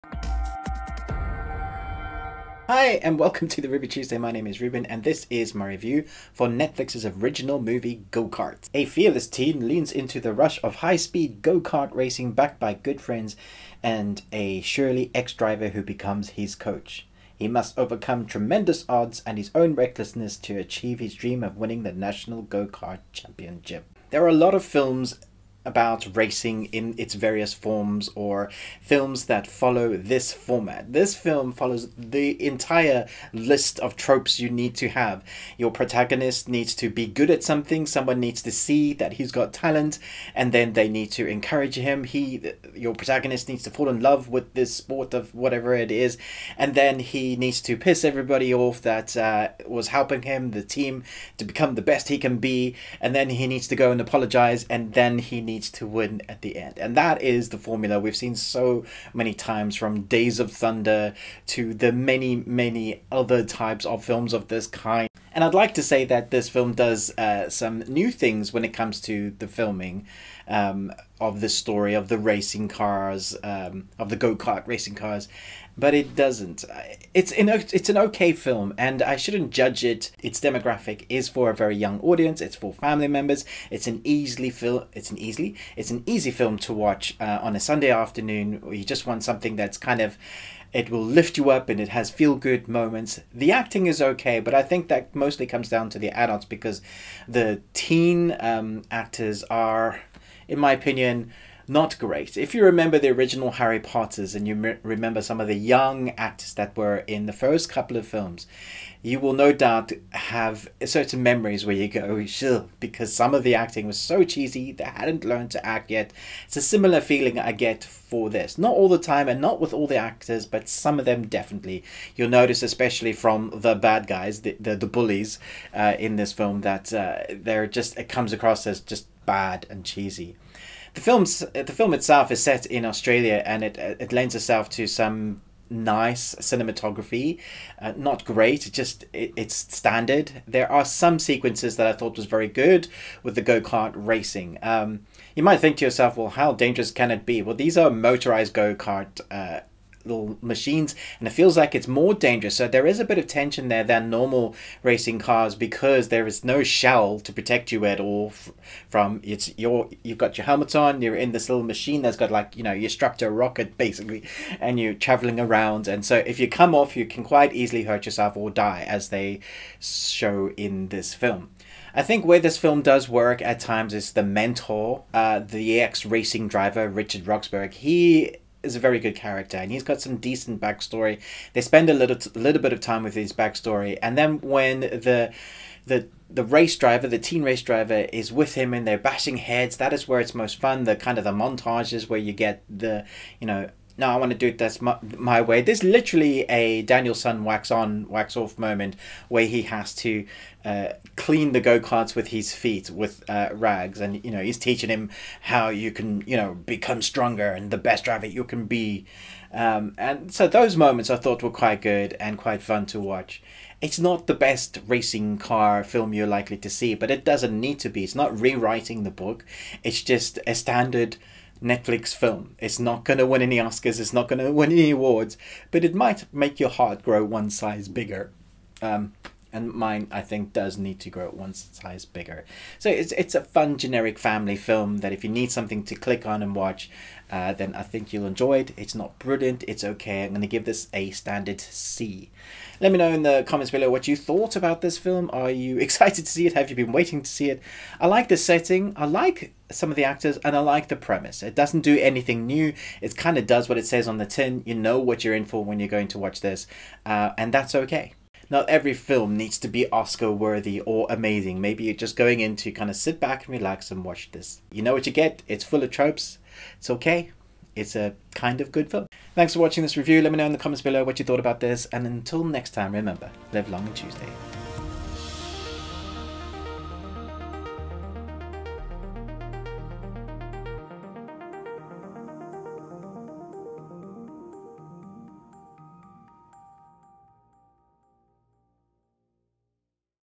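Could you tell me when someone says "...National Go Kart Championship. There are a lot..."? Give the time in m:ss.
0:21.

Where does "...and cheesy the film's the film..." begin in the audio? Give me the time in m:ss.
2:09.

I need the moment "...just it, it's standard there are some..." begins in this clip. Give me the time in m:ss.
2:18.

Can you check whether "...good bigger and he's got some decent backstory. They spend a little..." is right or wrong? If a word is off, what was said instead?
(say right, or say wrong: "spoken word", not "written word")
wrong: "character", not "bigger".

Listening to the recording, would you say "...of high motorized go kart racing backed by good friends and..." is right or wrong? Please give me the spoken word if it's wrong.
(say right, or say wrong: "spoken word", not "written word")
wrong: "speed", not "motorized".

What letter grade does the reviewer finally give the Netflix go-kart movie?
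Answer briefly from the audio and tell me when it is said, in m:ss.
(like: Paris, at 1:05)
C, at 4:01.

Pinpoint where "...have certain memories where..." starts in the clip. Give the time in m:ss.
1:50.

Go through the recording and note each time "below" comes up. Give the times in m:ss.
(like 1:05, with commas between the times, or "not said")
4:03, 4:30.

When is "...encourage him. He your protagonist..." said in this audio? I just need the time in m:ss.
0:41.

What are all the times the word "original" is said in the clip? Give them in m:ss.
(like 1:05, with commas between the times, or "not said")
0:07, 1:43.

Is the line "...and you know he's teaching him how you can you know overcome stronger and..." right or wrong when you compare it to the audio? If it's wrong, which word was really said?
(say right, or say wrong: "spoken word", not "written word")
wrong: "become", not "overcome".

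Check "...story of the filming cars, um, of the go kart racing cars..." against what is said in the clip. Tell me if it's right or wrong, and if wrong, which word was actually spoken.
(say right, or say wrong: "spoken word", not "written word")
wrong: "racing", not "filming".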